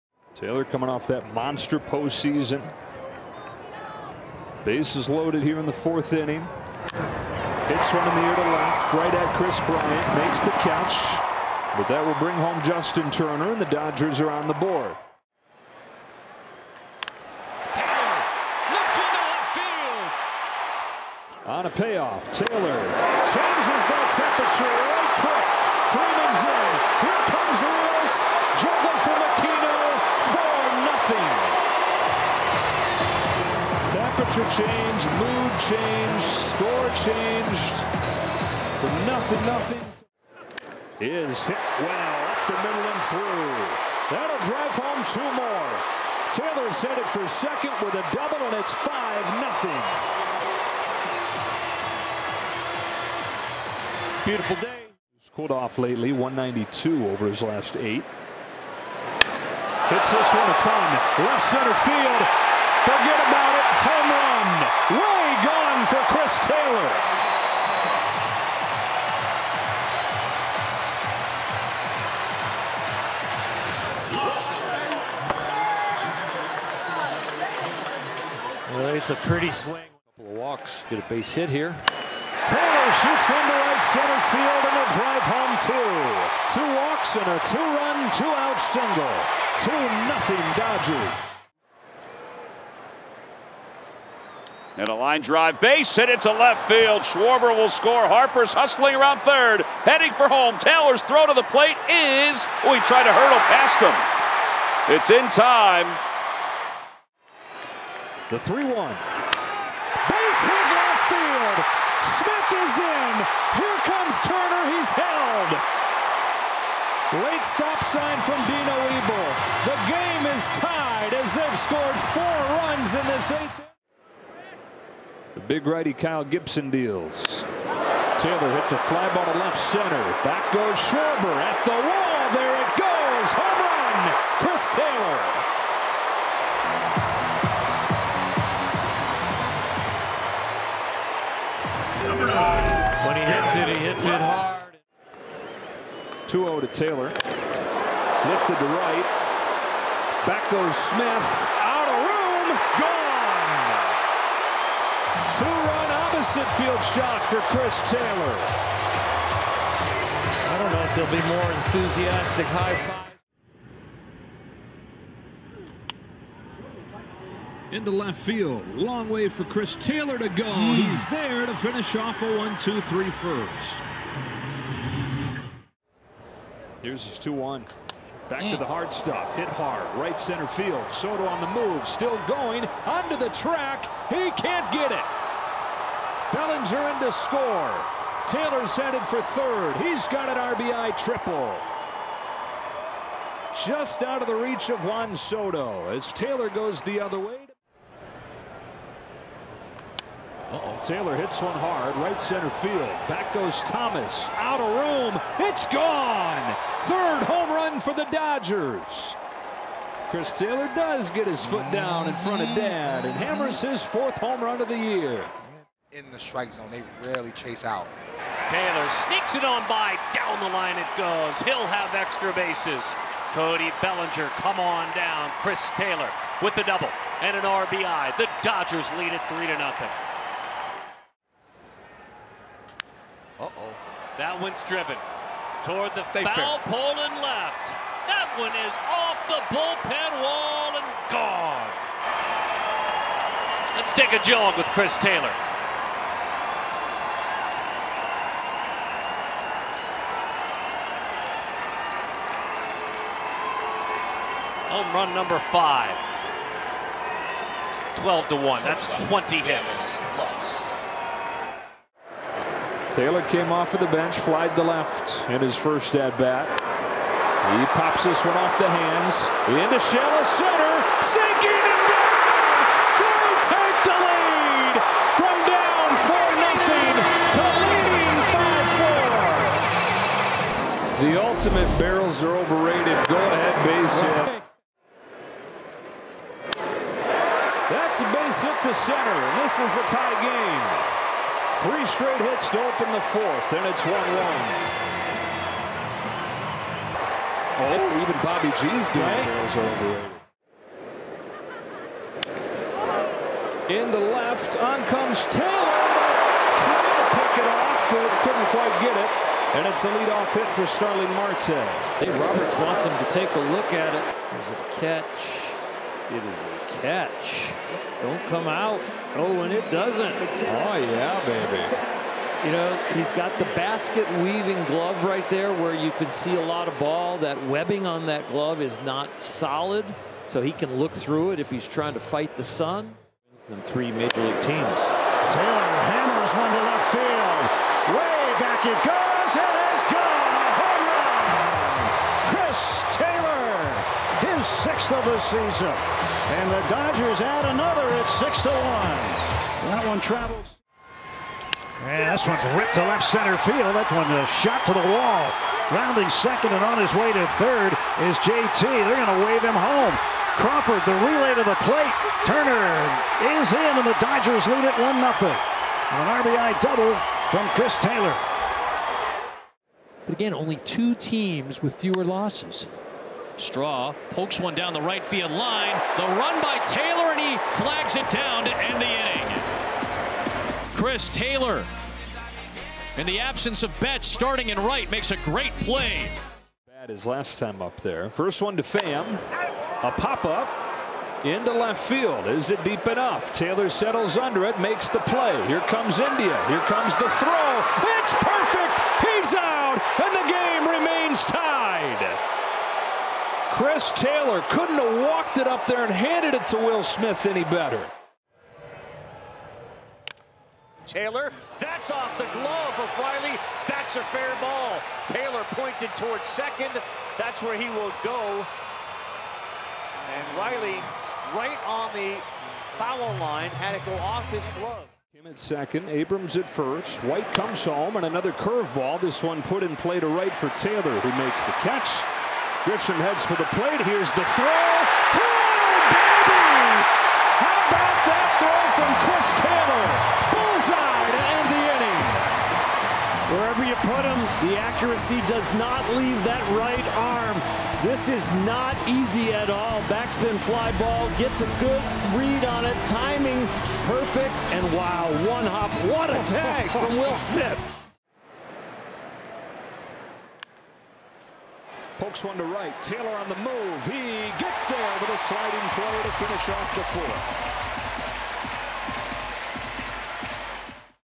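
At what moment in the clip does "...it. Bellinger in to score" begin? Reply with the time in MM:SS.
03:04.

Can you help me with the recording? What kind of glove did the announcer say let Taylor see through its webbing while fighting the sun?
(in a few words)
Basket weaving glove.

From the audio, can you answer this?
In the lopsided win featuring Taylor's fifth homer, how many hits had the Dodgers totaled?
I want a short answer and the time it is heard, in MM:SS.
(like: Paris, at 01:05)
20, at 04:19.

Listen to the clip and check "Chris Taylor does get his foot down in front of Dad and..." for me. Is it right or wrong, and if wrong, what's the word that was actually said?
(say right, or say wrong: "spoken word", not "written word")
right.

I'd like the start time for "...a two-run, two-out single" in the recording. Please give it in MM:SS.
01:27.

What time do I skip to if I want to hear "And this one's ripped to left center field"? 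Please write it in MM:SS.
05:51.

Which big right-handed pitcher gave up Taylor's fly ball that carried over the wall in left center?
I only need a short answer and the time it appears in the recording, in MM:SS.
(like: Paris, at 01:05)
Kyle Gibson, at 02:05.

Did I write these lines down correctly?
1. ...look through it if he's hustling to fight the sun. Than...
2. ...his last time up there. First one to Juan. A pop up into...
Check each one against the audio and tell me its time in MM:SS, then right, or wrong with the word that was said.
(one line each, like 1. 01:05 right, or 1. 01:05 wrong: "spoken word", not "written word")
1. 05:30 wrong: "trying", not "hustling"
2. 06:26 wrong: "Pham", not "Juan".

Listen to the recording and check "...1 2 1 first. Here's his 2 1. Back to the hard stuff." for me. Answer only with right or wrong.
wrong.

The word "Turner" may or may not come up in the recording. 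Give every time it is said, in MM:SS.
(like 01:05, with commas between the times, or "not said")
00:13, 01:54, 06:02.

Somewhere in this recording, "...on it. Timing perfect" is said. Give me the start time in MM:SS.
07:32.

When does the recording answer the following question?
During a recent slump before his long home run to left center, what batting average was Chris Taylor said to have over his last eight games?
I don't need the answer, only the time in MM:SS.
00:56.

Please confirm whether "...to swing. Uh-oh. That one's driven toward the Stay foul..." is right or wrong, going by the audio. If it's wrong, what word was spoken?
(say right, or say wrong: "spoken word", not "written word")
wrong: "nothing", not "swing".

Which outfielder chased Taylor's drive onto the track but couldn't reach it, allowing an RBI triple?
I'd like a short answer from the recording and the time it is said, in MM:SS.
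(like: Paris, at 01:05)
Juan Soto, at 03:14.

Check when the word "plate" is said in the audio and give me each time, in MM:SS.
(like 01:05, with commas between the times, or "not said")
01:41, 06:01, 07:13.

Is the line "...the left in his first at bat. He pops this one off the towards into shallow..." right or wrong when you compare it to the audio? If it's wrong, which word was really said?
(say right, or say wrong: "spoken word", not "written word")
wrong: "hands", not "towards".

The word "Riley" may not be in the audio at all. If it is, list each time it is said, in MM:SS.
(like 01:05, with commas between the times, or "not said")
06:52, 07:00.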